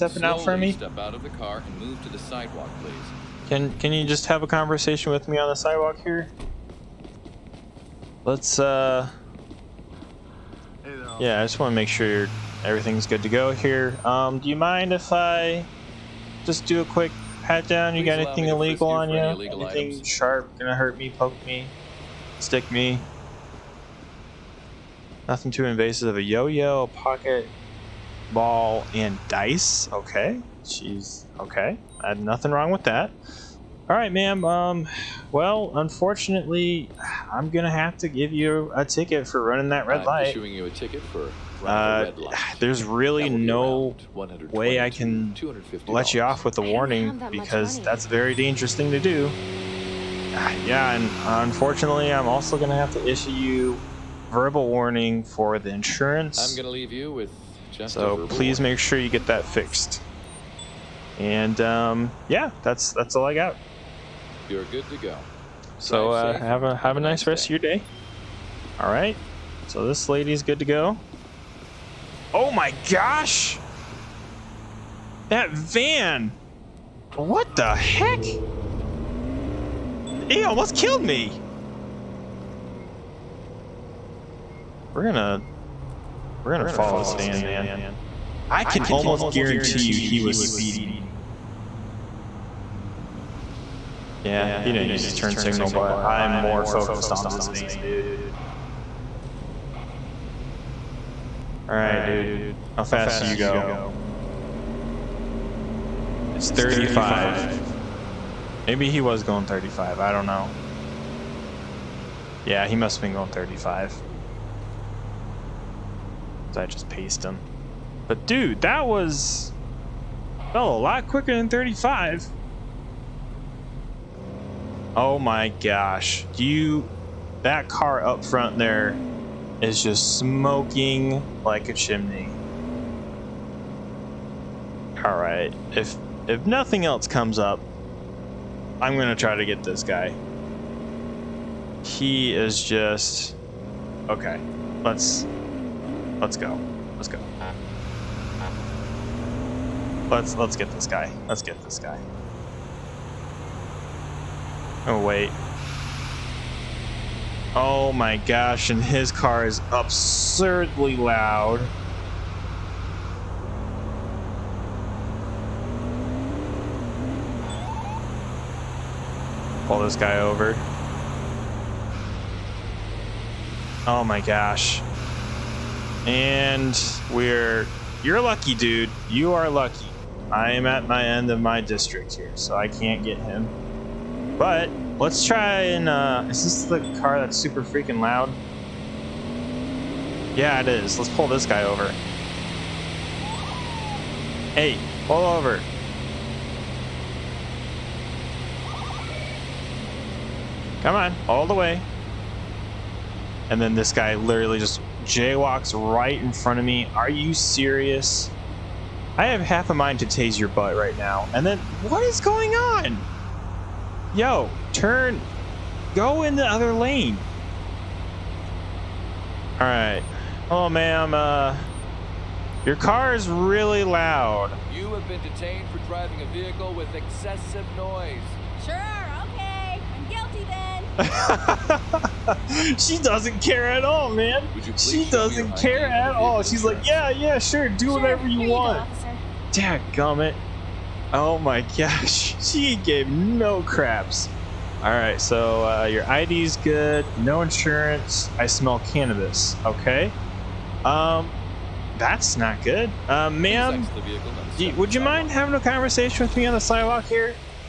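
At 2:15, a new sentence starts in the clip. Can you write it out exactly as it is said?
All right, if if nothing else comes up, I'm gonna try to get this guy.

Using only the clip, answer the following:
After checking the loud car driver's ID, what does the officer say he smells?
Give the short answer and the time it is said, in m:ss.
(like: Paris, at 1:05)
Cannabis, at 4:08.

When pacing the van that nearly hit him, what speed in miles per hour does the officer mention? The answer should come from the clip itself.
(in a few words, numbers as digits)
35.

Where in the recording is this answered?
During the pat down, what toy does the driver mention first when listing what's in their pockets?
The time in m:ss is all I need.
0:26.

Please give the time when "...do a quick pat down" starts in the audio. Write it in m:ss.
0:16.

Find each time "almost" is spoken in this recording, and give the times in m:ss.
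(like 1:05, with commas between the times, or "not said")
1:20, 1:28.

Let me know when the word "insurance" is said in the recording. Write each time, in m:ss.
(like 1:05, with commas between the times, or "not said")
0:55, 4:07.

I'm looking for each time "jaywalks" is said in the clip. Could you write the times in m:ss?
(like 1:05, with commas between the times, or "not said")
3:25.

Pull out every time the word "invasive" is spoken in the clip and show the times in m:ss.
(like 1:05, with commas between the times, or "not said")
0:25.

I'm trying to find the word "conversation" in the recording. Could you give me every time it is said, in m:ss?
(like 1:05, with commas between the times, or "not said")
0:04, 4:15.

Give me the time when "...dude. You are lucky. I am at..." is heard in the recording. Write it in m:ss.
2:58.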